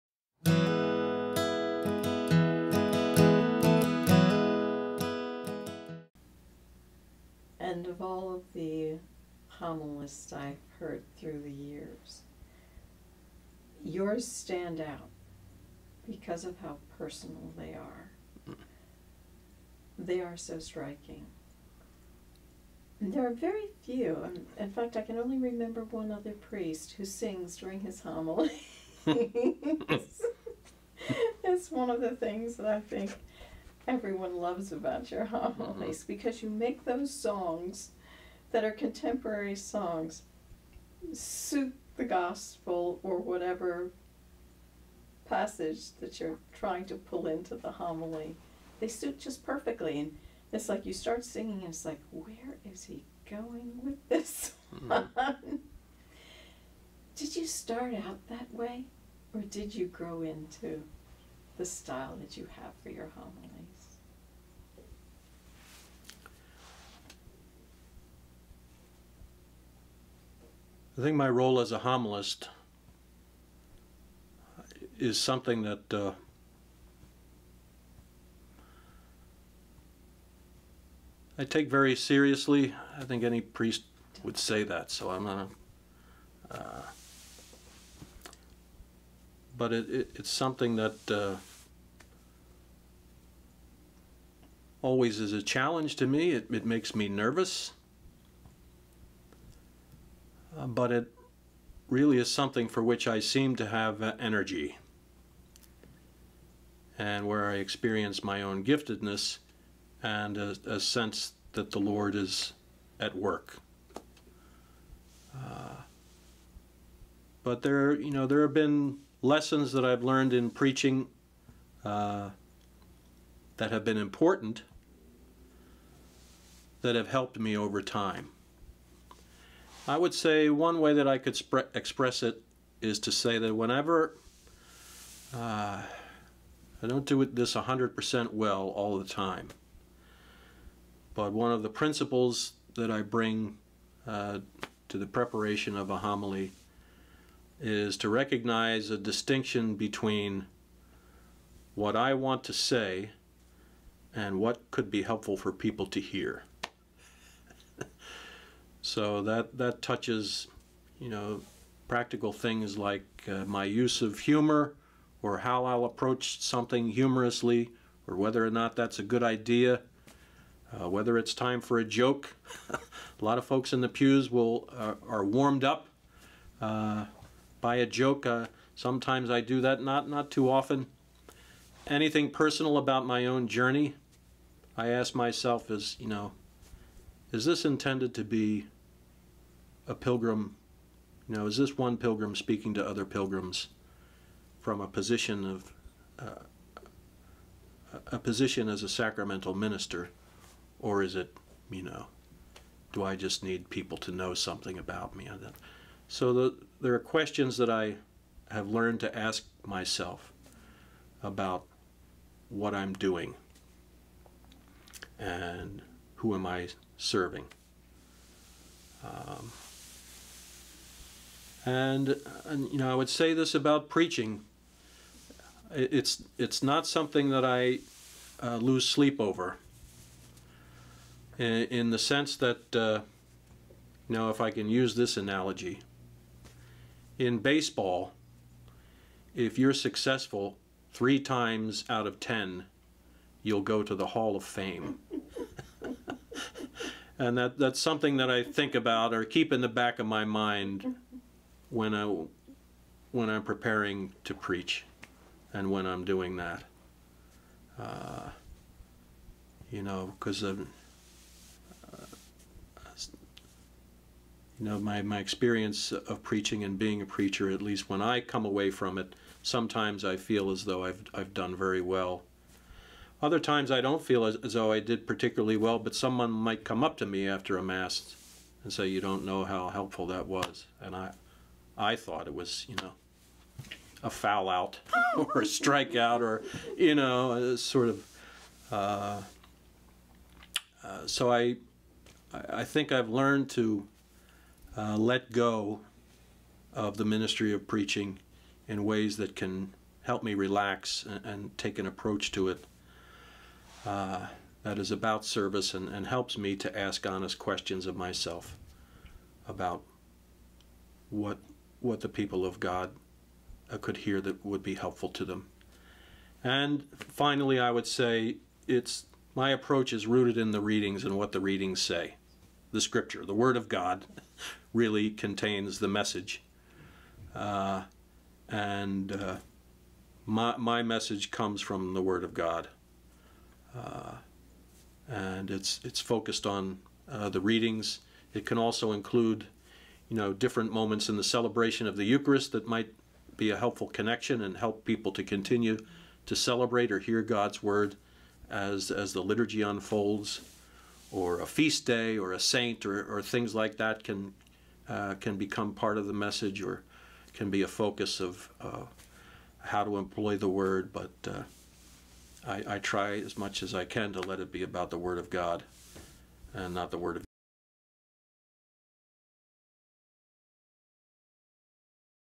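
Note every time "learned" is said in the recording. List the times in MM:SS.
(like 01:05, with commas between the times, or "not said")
02:00, 03:28, 04:53.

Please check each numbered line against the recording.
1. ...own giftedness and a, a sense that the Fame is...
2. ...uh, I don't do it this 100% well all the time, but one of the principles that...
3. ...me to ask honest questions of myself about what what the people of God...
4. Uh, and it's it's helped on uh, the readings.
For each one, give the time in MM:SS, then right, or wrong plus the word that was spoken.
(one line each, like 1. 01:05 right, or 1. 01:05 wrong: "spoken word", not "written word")
1. 01:48 wrong: "Lord", not "Fame"
2. 02:15 right
3. 05:06 right
4. 05:33 wrong: "focused", not "helped".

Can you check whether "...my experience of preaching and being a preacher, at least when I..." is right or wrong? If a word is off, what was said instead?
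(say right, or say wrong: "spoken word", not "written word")
right.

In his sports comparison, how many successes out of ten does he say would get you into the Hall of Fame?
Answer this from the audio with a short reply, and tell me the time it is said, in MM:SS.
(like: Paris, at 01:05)
3, at 04:00.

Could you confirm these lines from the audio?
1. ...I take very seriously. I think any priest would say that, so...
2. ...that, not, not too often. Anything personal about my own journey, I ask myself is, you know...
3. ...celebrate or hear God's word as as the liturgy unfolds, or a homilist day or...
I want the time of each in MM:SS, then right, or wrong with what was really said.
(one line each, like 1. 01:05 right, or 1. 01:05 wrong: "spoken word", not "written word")
1. 01:21 right
2. 02:59 right
3. 05:46 wrong: "feast", not "homilist".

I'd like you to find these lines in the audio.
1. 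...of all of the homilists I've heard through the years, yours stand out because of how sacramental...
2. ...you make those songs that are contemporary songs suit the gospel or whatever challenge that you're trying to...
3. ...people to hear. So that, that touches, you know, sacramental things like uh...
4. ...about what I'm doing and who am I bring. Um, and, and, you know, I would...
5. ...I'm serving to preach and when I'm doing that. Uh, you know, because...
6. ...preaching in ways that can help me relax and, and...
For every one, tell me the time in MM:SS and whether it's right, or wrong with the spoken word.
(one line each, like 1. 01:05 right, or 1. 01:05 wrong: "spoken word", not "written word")
1. 00:07 wrong: "personal", not "sacramental"
2. 00:36 wrong: "passage", not "challenge"
3. 02:35 wrong: "practical", not "sacramental"
4. 03:31 wrong: "serving", not "bring"
5. 04:13 wrong: "preparing", not "serving"
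6. 04:57 right.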